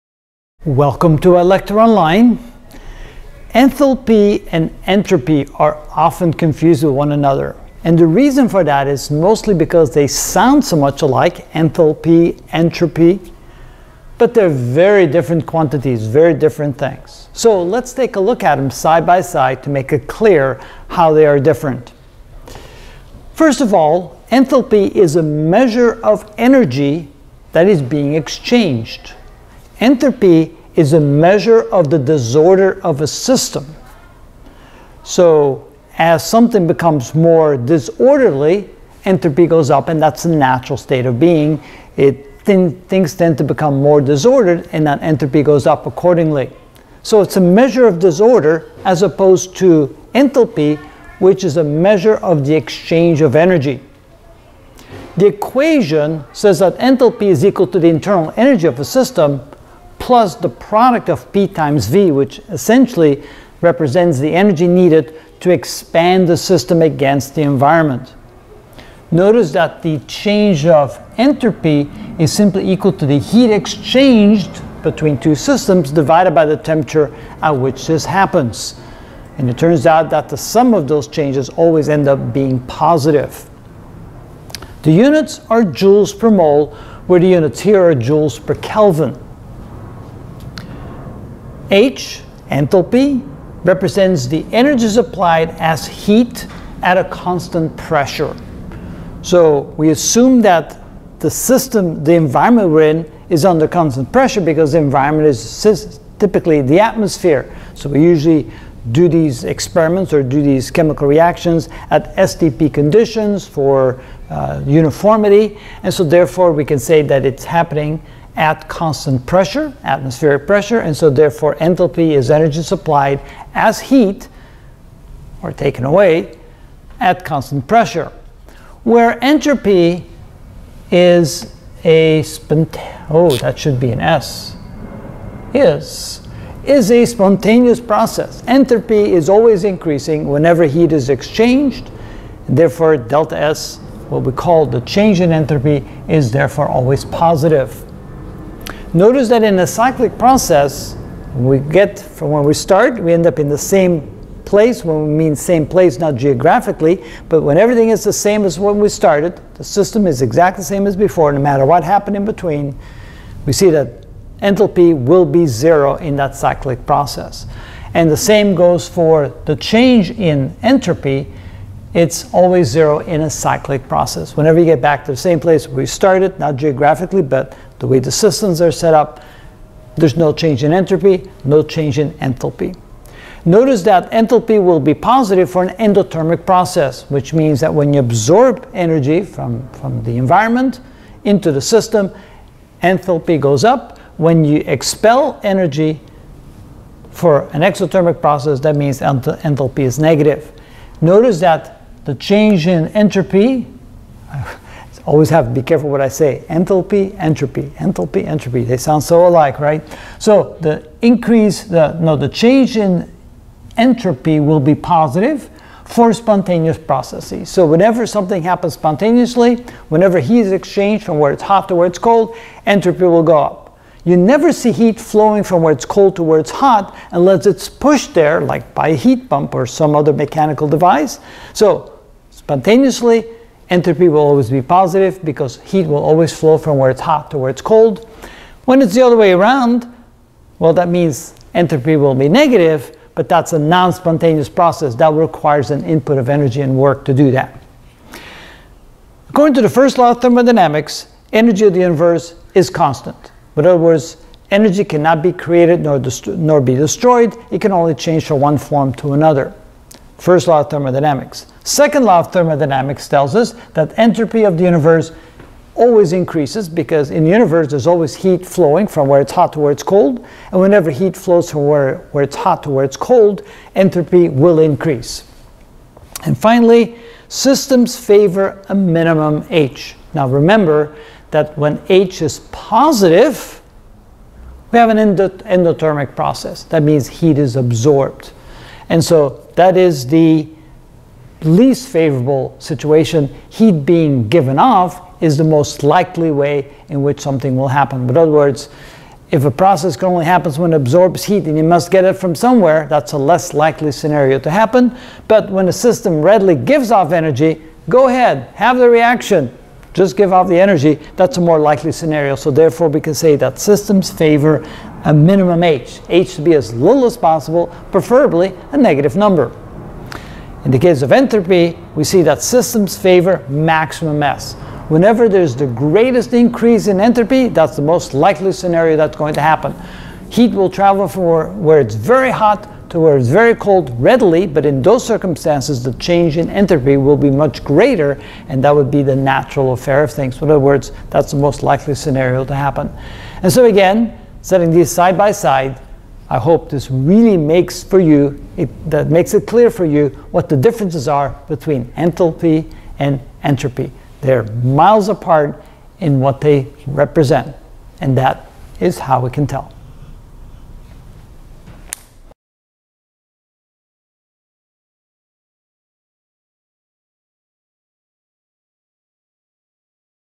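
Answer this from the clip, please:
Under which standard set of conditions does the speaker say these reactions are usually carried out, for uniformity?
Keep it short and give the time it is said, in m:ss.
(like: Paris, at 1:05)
STP, at 1:52.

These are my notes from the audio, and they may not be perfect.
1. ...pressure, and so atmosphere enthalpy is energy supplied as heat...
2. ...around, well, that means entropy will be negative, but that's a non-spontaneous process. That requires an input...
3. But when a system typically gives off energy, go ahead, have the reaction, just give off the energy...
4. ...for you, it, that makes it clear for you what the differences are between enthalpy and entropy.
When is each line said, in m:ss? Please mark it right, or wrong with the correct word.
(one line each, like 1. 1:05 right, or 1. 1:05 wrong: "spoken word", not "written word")
1. 2:00 wrong: "therefore", not "atmosphere"
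2. 3:59 right
3. 5:05 wrong: "readily", not "typically"
4. 5:47 right.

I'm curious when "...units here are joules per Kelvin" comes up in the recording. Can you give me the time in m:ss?
1:27.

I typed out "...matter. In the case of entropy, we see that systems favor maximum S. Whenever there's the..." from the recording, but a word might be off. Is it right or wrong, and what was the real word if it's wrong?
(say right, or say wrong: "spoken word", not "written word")
wrong: "number", not "matter".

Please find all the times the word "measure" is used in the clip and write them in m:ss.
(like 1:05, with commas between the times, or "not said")
0:25, 0:30, 0:47, 0:51.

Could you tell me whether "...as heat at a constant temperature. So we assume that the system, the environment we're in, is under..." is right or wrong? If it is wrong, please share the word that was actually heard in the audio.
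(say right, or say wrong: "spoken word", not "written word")
wrong: "pressure", not "temperature".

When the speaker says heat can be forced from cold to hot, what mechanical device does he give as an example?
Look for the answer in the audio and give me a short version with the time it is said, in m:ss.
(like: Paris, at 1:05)
heat pump, at 3:48.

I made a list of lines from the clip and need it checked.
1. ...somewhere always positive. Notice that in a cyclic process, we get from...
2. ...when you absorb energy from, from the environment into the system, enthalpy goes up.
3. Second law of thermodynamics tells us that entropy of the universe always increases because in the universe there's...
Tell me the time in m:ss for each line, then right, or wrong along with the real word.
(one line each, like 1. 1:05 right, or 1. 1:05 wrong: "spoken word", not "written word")
1. 2:26 wrong: "therefore", not "somewhere"
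2. 3:07 right
3. 4:21 right.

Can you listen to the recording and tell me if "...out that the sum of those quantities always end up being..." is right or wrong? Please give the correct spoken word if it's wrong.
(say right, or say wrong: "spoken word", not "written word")
wrong: "changes", not "quantities".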